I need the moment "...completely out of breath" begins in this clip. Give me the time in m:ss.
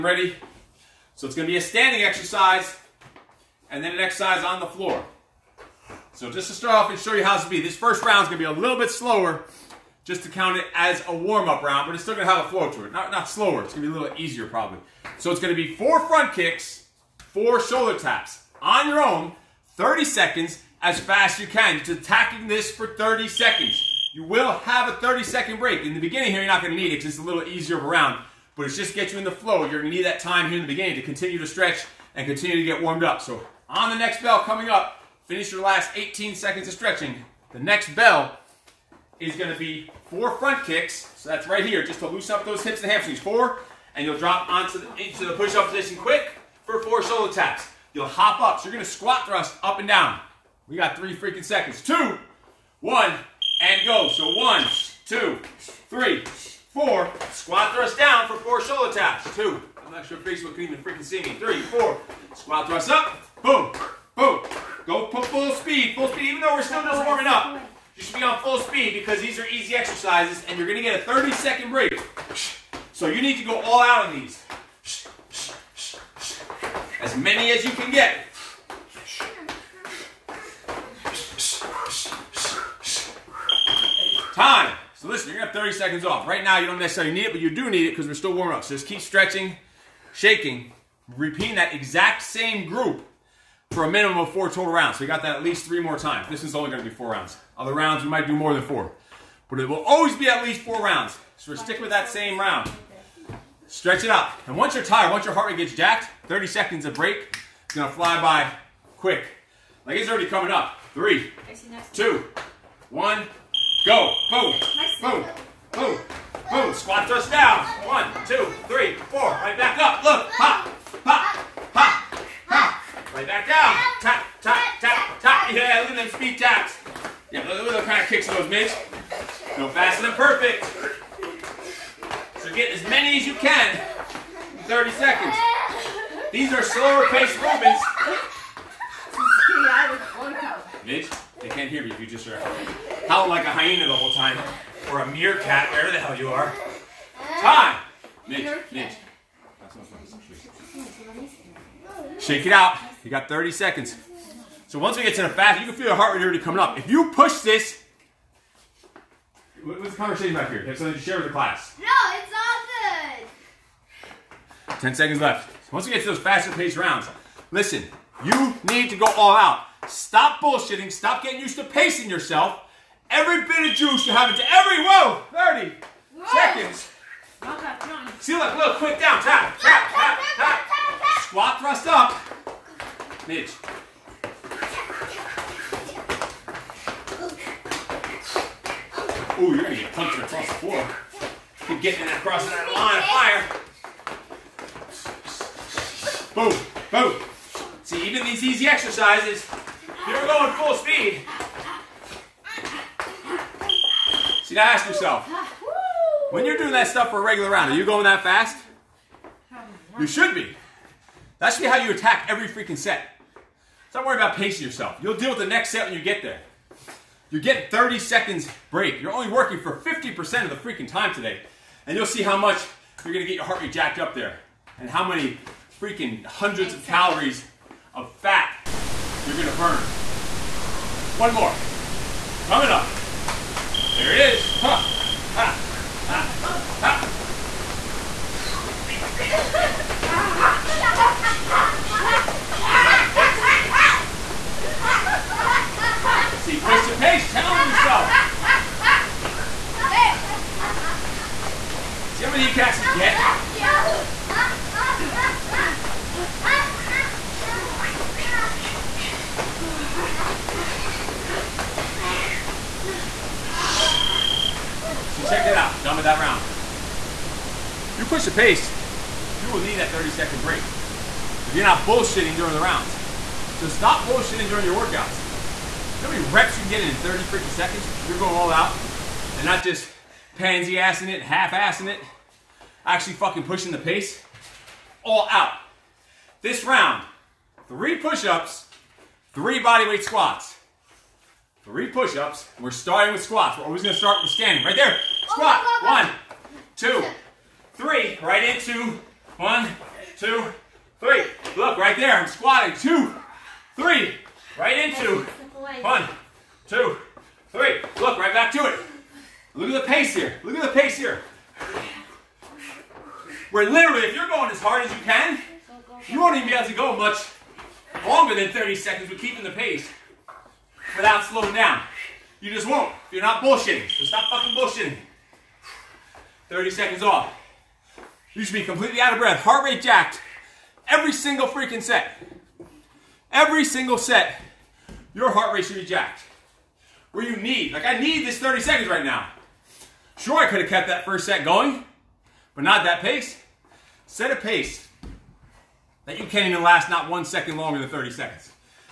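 5:28.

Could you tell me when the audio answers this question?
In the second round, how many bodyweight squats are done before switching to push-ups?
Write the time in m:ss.
4:49.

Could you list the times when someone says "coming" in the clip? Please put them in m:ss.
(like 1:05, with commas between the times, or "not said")
0:34, 1:50, 2:36, 3:52.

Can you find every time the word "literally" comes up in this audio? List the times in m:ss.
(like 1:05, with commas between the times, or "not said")
5:13.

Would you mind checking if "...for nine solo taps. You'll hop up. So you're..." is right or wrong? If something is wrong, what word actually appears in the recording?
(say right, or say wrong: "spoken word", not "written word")
wrong: "four", not "nine".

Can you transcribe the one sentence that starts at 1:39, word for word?
But it will always be at least four rounds.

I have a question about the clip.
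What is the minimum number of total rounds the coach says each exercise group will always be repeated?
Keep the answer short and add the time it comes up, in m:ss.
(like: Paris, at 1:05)
4, at 1:33.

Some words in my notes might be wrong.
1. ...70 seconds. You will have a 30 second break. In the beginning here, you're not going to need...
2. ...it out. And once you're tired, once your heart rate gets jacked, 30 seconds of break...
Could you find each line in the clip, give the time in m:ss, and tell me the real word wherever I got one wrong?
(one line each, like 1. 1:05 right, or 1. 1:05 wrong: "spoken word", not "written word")
1. 0:22 wrong: "30", not "70"
2. 1:44 right.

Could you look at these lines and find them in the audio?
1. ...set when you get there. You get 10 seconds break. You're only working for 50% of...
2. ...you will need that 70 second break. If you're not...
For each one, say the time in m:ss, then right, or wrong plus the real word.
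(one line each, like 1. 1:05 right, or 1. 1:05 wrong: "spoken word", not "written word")
1. 3:35 wrong: "30", not "10"
2. 4:29 wrong: "30", not "70".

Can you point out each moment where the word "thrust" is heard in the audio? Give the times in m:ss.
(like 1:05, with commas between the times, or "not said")
0:49, 0:57, 1:02, 1:57, 3:01.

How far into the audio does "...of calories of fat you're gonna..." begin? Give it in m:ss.
3:46.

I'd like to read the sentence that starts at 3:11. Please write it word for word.
Keep getting that across that line of fire.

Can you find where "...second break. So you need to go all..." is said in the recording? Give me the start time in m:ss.
1:11.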